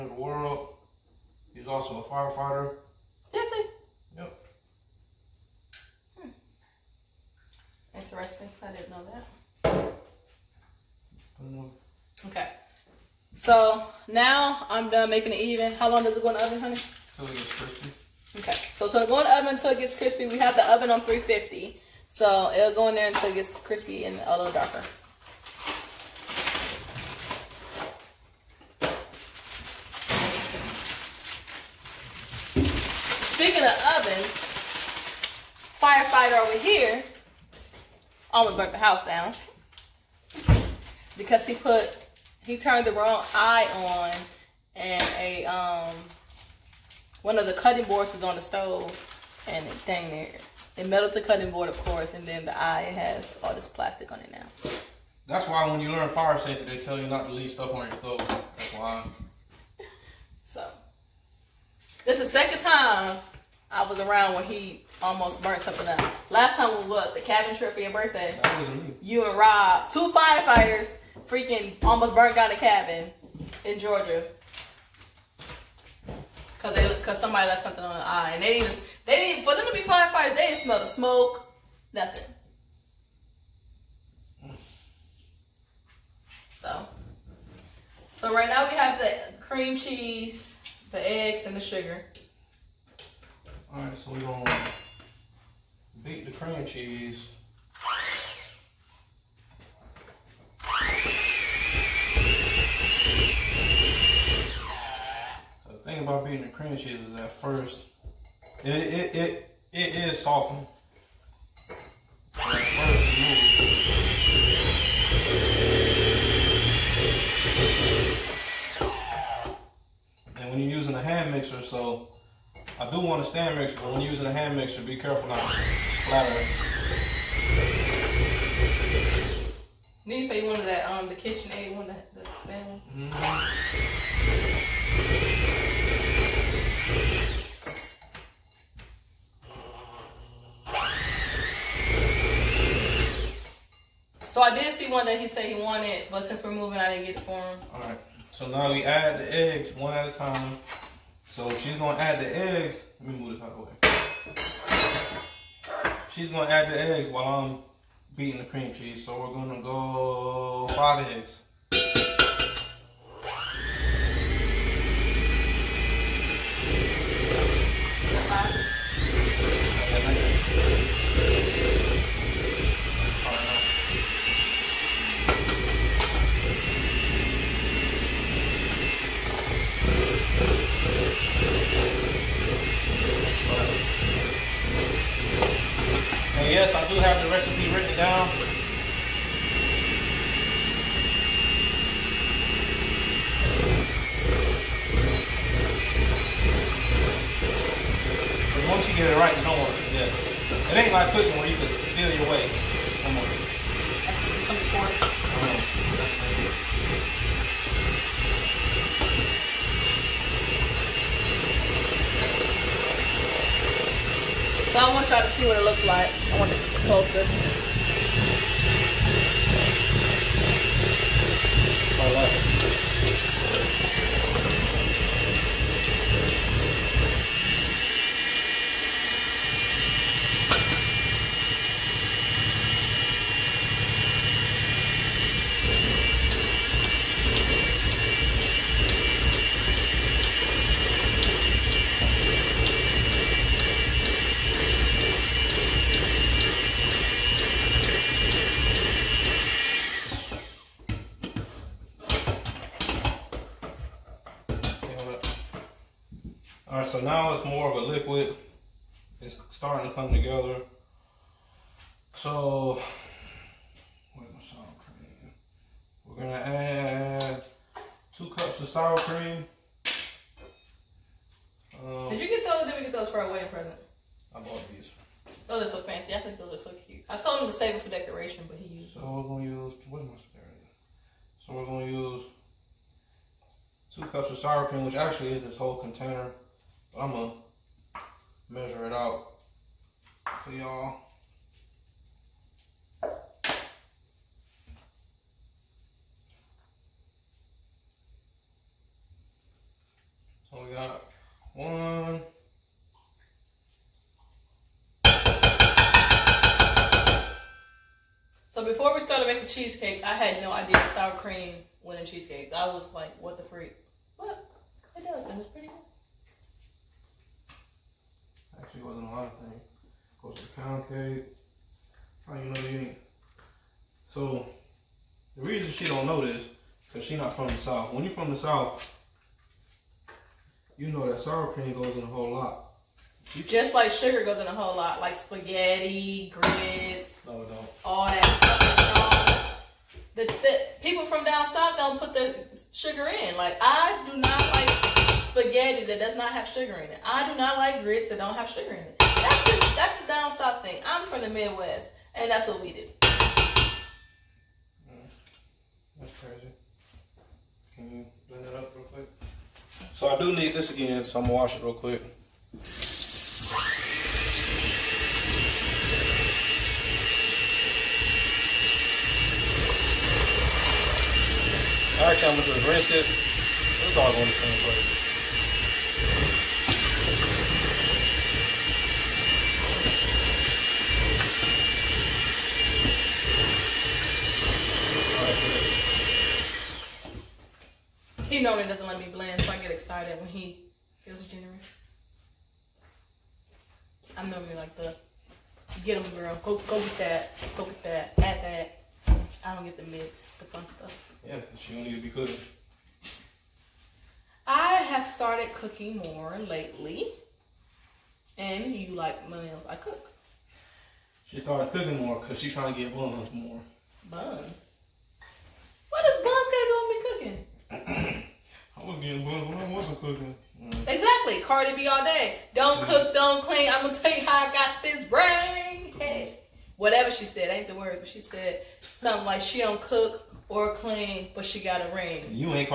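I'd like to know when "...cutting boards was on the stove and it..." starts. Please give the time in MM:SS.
00:47.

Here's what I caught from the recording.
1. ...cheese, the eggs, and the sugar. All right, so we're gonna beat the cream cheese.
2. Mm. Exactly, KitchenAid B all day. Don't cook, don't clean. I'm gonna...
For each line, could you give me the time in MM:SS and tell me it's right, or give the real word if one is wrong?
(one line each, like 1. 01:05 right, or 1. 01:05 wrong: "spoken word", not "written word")
1. 01:29 right
2. 07:00 wrong: "Cardi", not "KitchenAid".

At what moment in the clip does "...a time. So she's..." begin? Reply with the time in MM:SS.
02:30.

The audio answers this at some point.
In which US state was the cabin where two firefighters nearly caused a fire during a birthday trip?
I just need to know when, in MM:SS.
01:13.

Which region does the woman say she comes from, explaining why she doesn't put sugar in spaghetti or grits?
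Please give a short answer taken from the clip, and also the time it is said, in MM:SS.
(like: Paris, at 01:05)
Midwest, at 05:51.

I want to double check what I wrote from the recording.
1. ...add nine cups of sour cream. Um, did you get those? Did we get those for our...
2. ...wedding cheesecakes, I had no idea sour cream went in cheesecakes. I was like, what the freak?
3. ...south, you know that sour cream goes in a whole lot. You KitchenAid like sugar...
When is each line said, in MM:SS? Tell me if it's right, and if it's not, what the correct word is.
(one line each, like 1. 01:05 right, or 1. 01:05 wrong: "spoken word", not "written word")
1. 04:26 wrong: "two", not "nine"
2. 05:09 wrong: "making", not "wedding"
3. 05:28 wrong: "Just", not "KitchenAid".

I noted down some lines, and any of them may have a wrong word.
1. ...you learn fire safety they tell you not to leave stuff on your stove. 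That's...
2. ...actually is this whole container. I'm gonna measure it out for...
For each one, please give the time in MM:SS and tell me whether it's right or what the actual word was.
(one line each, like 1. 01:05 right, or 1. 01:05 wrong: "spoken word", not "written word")
1. 00:55 right
2. 04:44 right.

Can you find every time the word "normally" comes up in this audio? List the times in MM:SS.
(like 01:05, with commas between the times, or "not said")
06:28, 06:34.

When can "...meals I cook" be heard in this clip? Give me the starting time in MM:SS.
06:49.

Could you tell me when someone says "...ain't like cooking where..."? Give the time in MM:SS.
03:20.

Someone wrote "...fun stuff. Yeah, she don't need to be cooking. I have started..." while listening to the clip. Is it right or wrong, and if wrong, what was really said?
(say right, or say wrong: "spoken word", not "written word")
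right.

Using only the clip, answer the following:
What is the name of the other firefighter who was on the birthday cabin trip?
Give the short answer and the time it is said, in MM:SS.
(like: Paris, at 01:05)
Rob, at 01:09.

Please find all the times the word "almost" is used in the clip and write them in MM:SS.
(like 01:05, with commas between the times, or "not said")
00:38, 01:05, 01:11.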